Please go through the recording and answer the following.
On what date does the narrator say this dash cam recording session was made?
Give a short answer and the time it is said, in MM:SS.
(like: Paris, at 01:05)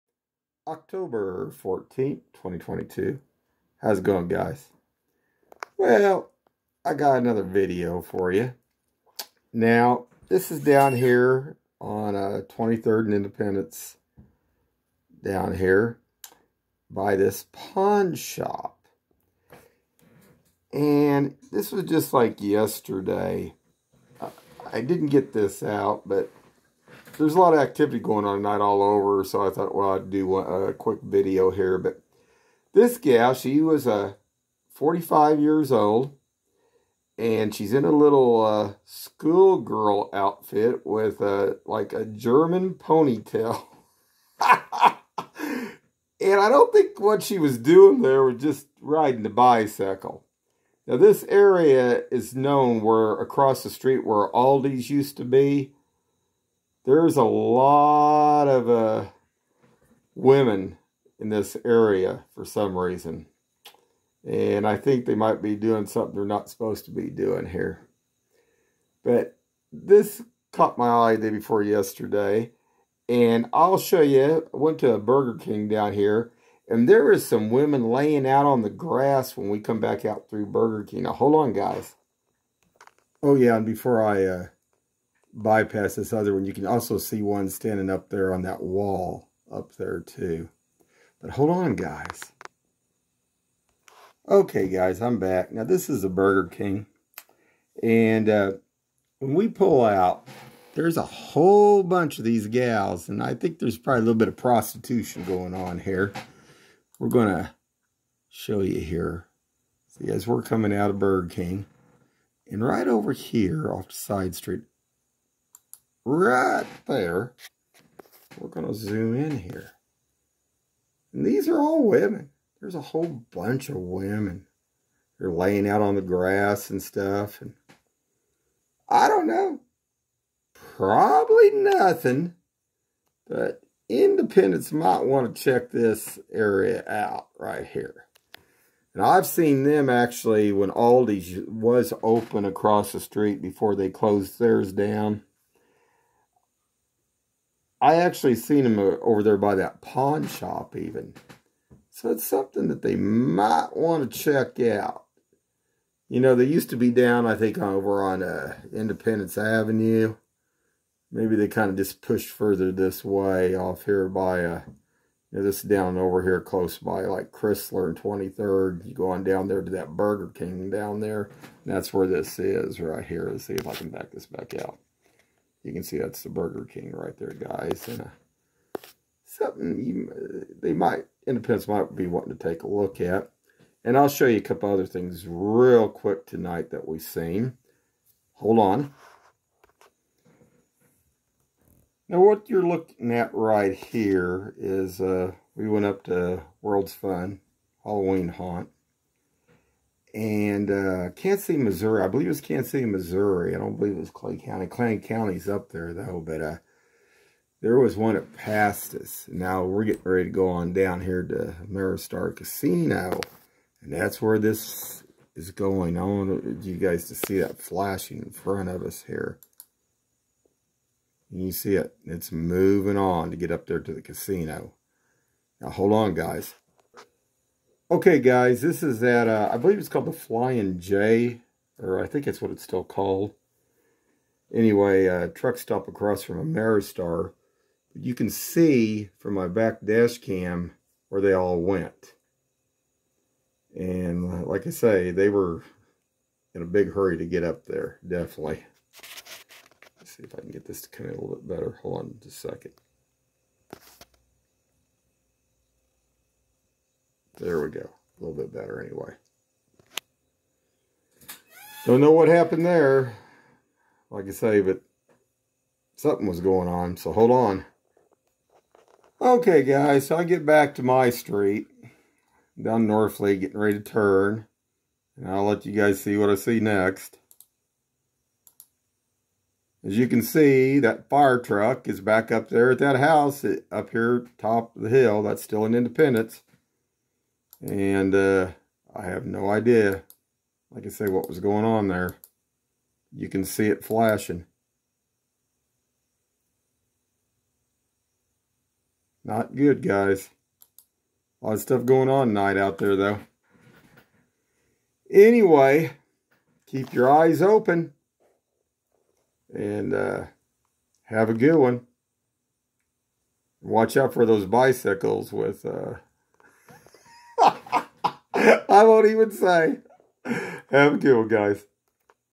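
October 14, 2022, at 00:00.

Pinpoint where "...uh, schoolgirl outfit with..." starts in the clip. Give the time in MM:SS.
00:38.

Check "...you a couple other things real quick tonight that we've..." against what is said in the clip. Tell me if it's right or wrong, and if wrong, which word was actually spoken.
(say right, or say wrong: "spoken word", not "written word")
right.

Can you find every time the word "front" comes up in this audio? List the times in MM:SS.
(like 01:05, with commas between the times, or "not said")
03:38.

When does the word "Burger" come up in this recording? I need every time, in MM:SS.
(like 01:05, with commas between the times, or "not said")
01:14, 01:20, 01:36, 01:50, 02:49, 02:56.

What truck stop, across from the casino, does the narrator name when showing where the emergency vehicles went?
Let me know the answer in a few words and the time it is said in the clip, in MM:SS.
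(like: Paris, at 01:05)
Flying J, at 03:50.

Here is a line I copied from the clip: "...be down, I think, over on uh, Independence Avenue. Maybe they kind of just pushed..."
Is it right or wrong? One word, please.
right.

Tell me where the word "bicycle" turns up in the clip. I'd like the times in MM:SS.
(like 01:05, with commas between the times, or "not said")
00:49, 05:14.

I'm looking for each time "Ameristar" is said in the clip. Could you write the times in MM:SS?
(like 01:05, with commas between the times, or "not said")
03:31, 03:56.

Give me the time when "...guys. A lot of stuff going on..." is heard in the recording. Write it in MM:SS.
04:59.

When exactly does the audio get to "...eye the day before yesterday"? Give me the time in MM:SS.
01:11.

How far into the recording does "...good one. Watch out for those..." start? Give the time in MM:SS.
05:11.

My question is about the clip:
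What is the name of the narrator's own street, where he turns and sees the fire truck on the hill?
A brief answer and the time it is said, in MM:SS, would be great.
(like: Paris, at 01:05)
Northley, at 04:32.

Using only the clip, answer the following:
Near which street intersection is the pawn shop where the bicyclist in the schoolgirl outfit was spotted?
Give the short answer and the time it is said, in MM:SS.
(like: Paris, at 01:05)
23rd and Independence, at 00:12.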